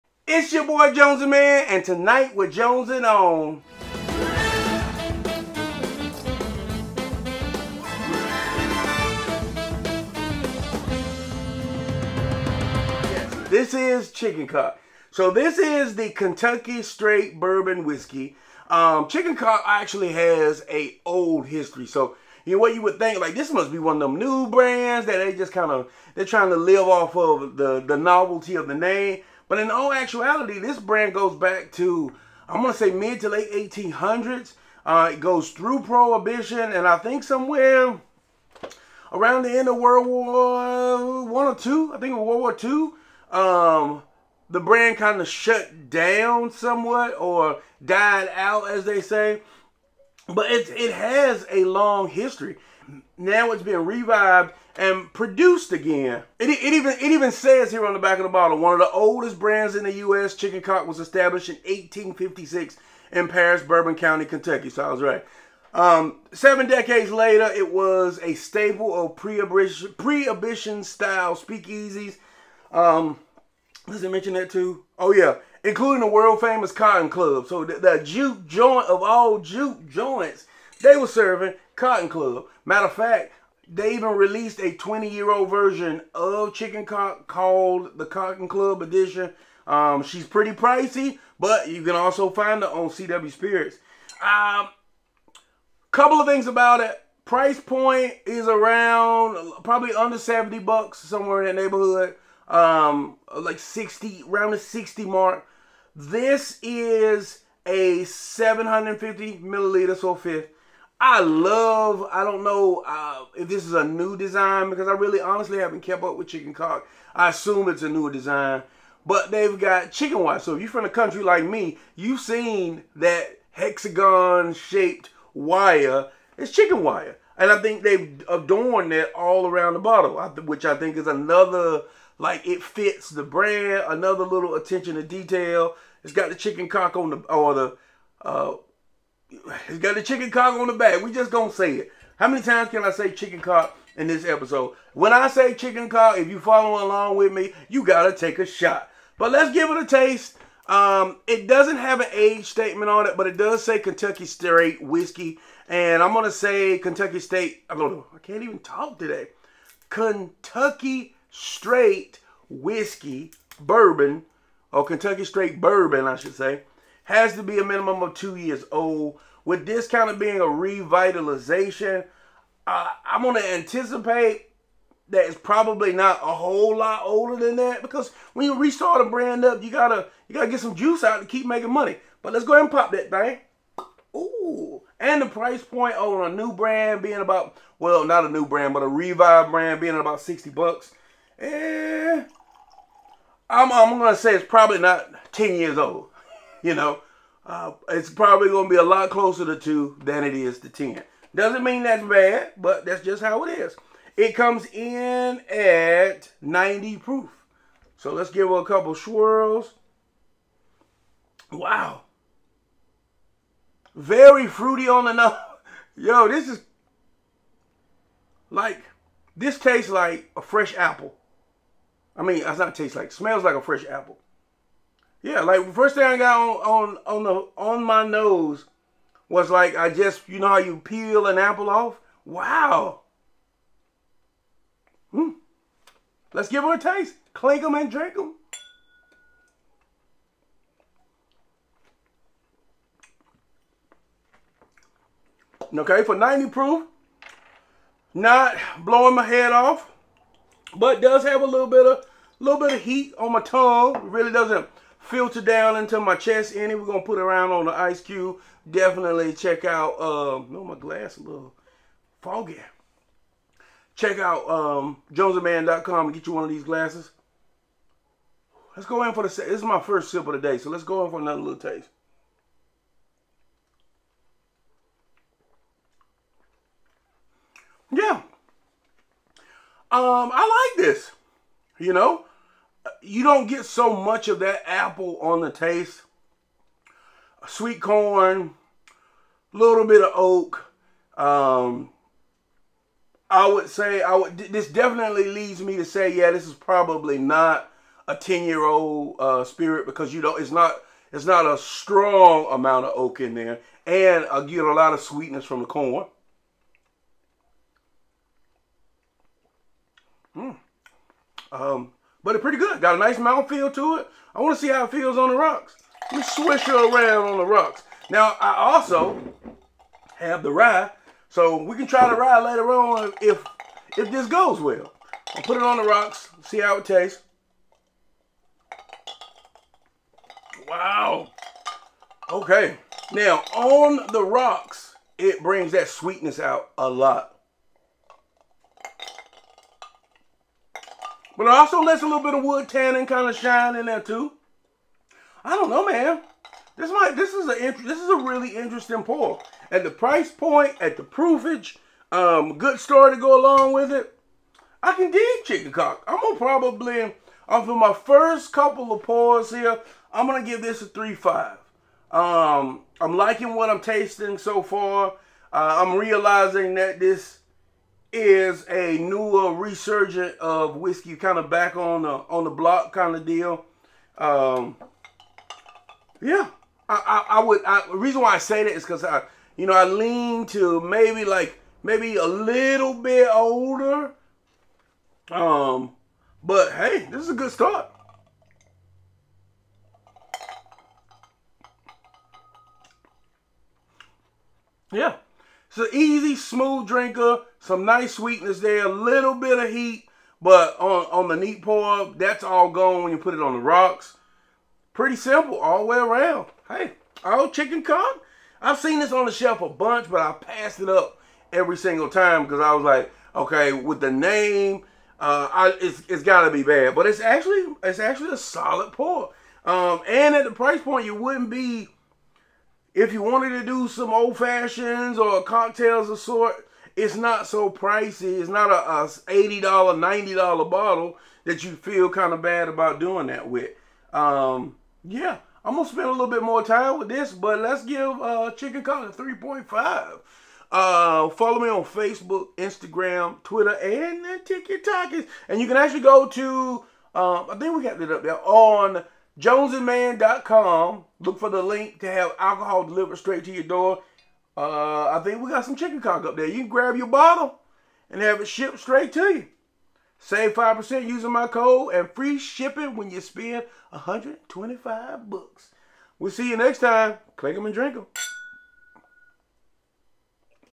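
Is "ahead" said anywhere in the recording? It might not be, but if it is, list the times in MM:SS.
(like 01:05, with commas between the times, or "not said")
03:02.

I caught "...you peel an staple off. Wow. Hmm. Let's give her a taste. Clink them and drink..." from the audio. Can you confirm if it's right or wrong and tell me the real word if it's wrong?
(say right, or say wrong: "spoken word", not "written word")
wrong: "apple", not "staple".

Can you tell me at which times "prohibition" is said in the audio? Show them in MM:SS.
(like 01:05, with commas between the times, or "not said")
00:35, 01:09.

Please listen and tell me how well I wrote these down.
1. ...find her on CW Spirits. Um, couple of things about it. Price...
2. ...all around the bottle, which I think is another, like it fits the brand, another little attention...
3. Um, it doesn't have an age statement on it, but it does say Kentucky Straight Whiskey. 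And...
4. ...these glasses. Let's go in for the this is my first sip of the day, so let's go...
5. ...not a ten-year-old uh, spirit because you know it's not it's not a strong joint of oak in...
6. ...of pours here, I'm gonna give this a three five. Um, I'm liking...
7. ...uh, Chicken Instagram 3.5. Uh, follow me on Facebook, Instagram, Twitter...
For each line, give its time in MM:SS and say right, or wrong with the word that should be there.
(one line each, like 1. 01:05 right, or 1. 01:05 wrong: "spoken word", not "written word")
1. 01:32 right
2. 02:09 right
3. 02:30 right
4. 04:26 right
5. 04:57 wrong: "amount", not "joint"
6. 05:58 right
7. 07:18 wrong: "Cock", not "Instagram".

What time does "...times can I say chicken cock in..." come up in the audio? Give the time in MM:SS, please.
02:22.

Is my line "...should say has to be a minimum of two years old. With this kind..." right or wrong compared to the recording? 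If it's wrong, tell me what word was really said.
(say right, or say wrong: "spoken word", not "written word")
right.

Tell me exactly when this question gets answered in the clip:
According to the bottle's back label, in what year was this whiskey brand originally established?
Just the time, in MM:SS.
01:01.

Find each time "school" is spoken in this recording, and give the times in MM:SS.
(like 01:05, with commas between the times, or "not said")
not said.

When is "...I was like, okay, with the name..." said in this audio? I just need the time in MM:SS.
06:52.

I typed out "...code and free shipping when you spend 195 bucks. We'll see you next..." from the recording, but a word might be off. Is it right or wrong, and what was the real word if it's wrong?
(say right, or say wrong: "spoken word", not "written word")
wrong: "125", not "195".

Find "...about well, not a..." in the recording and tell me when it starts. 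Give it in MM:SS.
03:07.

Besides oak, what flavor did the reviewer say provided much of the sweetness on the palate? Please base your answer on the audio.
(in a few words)
Sweet corn.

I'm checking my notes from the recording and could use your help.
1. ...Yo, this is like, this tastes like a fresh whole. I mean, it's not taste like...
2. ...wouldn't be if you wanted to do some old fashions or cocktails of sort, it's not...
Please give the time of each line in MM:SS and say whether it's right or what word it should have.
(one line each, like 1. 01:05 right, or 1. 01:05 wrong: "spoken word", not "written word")
1. 03:35 wrong: "apple", not "whole"
2. 07:01 right.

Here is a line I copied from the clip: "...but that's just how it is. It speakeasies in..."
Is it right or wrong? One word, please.
wrong.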